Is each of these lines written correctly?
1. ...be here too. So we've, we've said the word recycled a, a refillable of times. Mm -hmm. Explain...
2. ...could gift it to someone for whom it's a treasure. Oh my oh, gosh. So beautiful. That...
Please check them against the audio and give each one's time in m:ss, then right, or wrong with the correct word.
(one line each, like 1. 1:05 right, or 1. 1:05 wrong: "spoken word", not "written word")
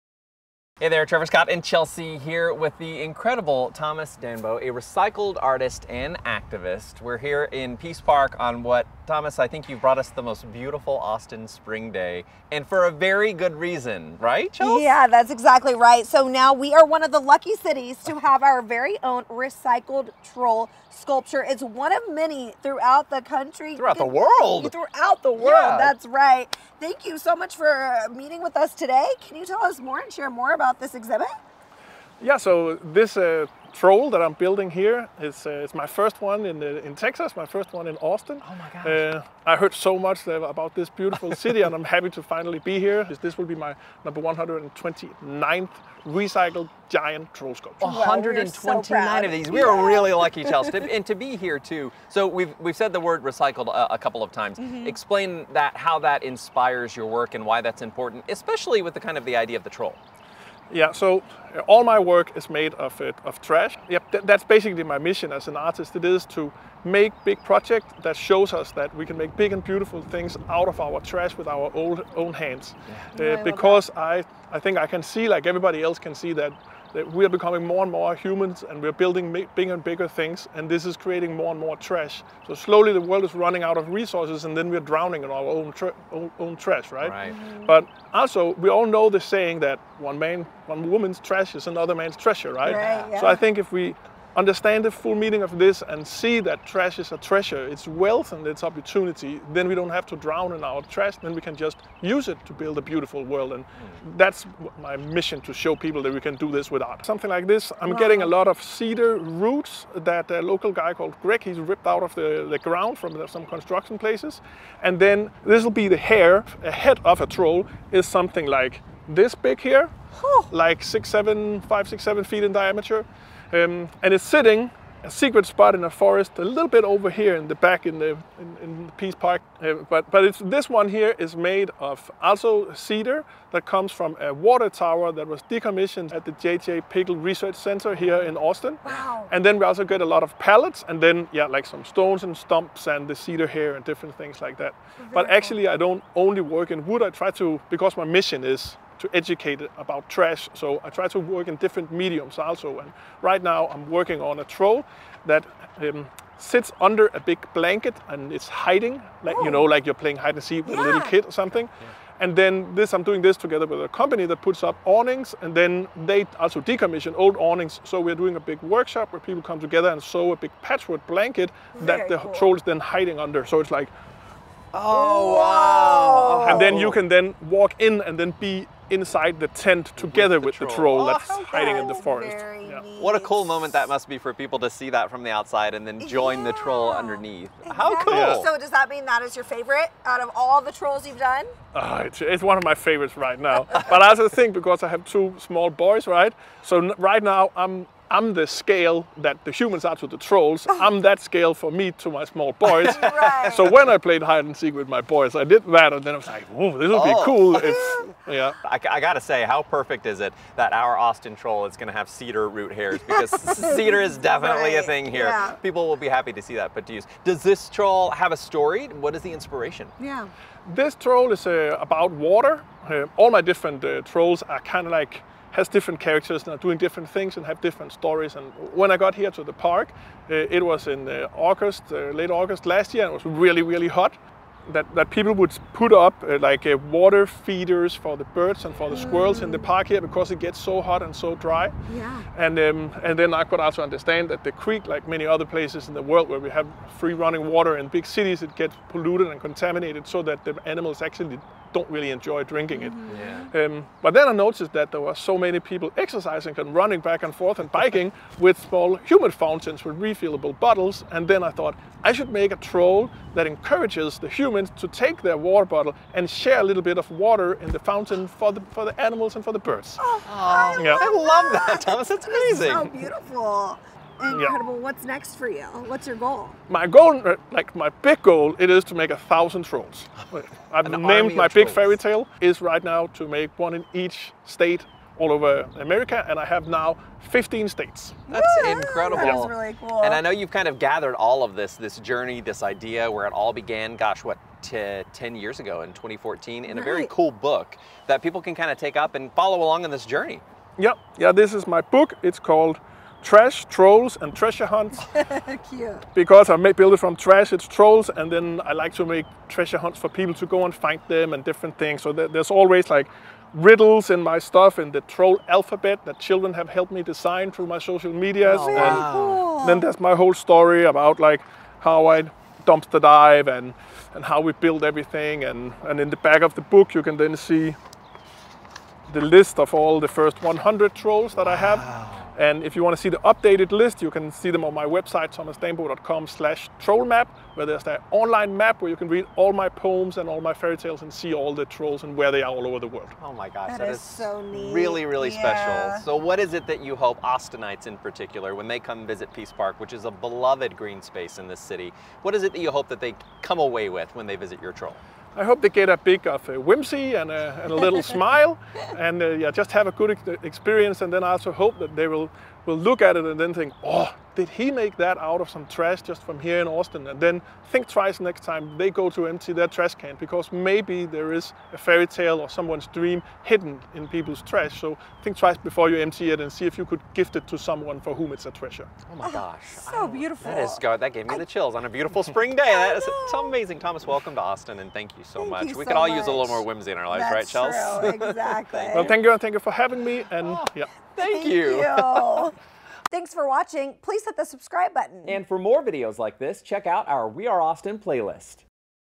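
1. 0:51 wrong: "couple", not "refillable"
2. 6:16 right.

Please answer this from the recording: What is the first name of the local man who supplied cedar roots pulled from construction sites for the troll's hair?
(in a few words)
Greg.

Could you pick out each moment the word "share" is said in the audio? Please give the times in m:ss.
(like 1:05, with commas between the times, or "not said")
0:30, 4:26.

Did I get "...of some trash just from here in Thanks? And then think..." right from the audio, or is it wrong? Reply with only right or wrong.
wrong.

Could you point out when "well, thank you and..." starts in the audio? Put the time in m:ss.
6:28.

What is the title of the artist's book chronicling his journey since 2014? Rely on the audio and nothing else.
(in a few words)
Trash, Trolls, and Treasure Hunts.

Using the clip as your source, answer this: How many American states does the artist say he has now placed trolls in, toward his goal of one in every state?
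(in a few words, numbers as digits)
15.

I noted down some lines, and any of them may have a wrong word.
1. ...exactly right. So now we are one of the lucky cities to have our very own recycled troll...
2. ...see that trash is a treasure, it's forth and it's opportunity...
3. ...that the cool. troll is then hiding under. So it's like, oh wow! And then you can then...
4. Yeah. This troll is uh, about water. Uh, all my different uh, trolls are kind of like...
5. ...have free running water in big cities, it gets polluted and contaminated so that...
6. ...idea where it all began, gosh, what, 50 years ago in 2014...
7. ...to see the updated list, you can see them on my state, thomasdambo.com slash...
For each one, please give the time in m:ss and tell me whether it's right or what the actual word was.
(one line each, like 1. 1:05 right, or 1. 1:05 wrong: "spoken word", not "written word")
1. 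0:15 right
2. 1:36 wrong: "wealth", not "forth"
3. 2:51 right
4. 3:40 right
5. 4:06 right
6. 4:52 wrong: "10", not "50"
7. 5:32 wrong: "website", not "state".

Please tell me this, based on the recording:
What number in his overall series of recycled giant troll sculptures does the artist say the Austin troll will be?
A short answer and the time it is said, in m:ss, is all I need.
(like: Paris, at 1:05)
129, at 0:44.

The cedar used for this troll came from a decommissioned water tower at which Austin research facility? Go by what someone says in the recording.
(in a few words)
J.J. Pickle Research Center.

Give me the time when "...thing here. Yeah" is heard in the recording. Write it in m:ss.
3:34.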